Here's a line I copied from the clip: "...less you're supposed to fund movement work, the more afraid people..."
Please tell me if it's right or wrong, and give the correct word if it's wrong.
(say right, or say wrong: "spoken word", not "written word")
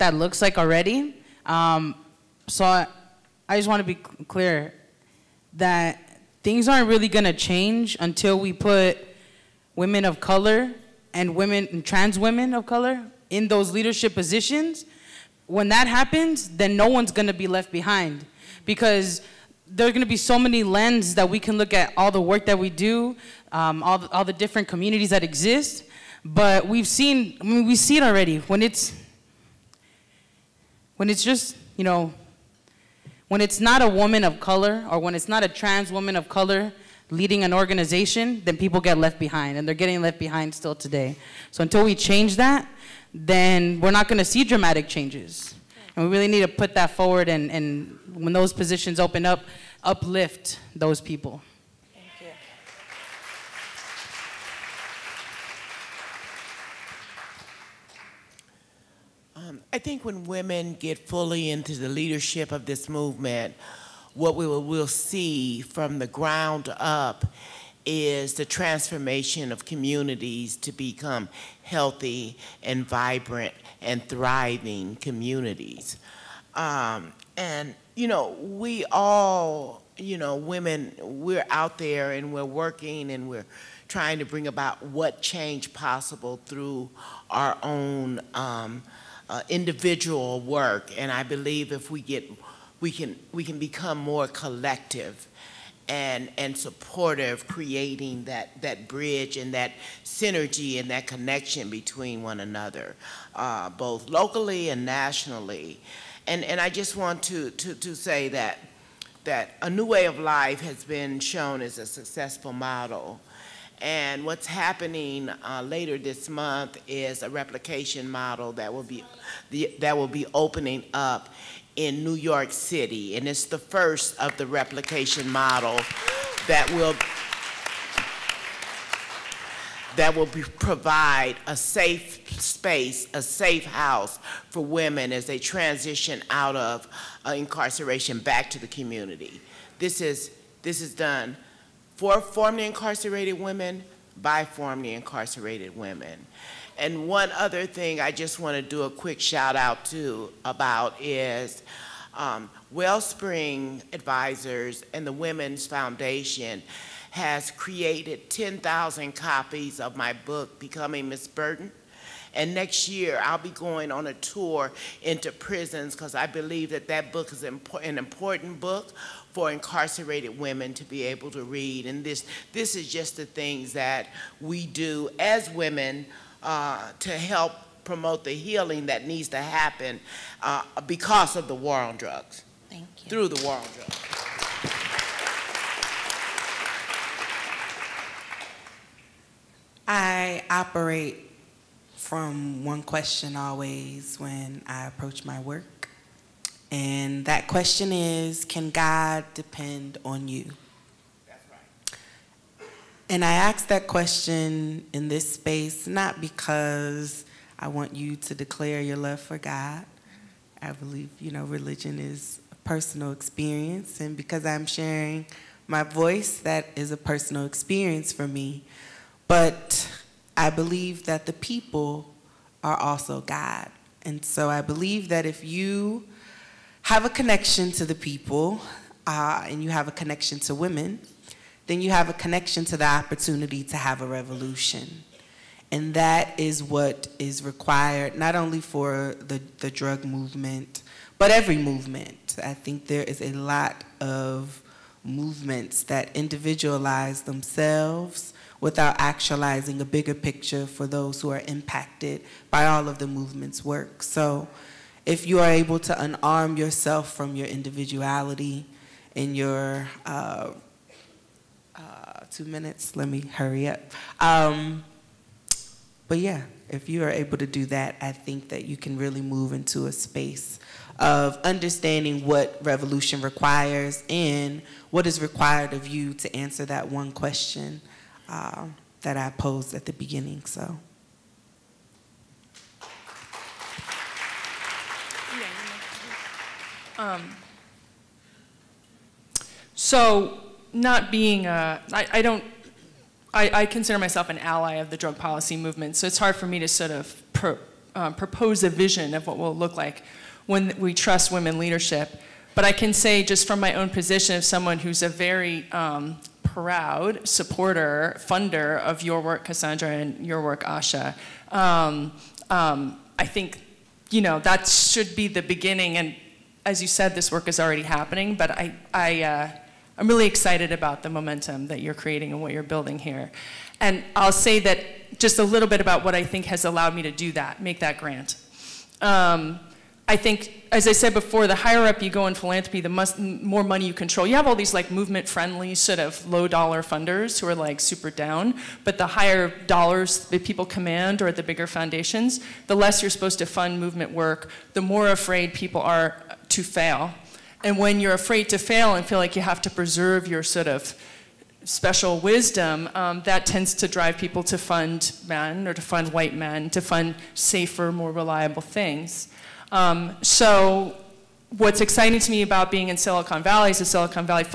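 right.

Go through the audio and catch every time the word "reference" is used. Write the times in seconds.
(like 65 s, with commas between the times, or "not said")
not said.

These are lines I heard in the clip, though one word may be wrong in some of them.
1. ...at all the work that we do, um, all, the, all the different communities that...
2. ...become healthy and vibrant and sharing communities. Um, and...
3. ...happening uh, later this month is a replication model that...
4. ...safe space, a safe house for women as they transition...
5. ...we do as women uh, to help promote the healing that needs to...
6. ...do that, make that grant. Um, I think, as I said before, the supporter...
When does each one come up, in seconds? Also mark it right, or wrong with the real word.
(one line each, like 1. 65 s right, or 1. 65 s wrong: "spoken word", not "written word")
1. 21 s right
2. 70 s wrong: "thriving", not "sharing"
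3. 114 s right
4. 131 s right
5. 174 s right
6. 327 s wrong: "higher", not "supporter".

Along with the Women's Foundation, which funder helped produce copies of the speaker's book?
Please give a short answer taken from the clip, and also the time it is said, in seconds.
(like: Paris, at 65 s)
Wellspring Advisors, at 152 s.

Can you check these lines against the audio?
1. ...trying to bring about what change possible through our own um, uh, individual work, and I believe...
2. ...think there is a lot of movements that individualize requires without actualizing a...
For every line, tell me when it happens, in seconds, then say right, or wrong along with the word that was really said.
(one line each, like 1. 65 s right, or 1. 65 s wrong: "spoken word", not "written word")
1. 83 s right
2. 242 s wrong: "themselves", not "requires".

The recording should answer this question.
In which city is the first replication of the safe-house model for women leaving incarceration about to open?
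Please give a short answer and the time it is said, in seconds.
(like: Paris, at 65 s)
New York City, at 122 s.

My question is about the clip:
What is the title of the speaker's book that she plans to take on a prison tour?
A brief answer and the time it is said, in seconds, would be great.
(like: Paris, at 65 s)
Becoming Miss Burton, at 160 s.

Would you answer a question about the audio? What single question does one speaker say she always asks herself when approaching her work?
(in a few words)
Can God depend on you?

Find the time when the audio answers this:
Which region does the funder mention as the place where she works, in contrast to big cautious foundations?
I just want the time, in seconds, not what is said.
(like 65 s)
362 s.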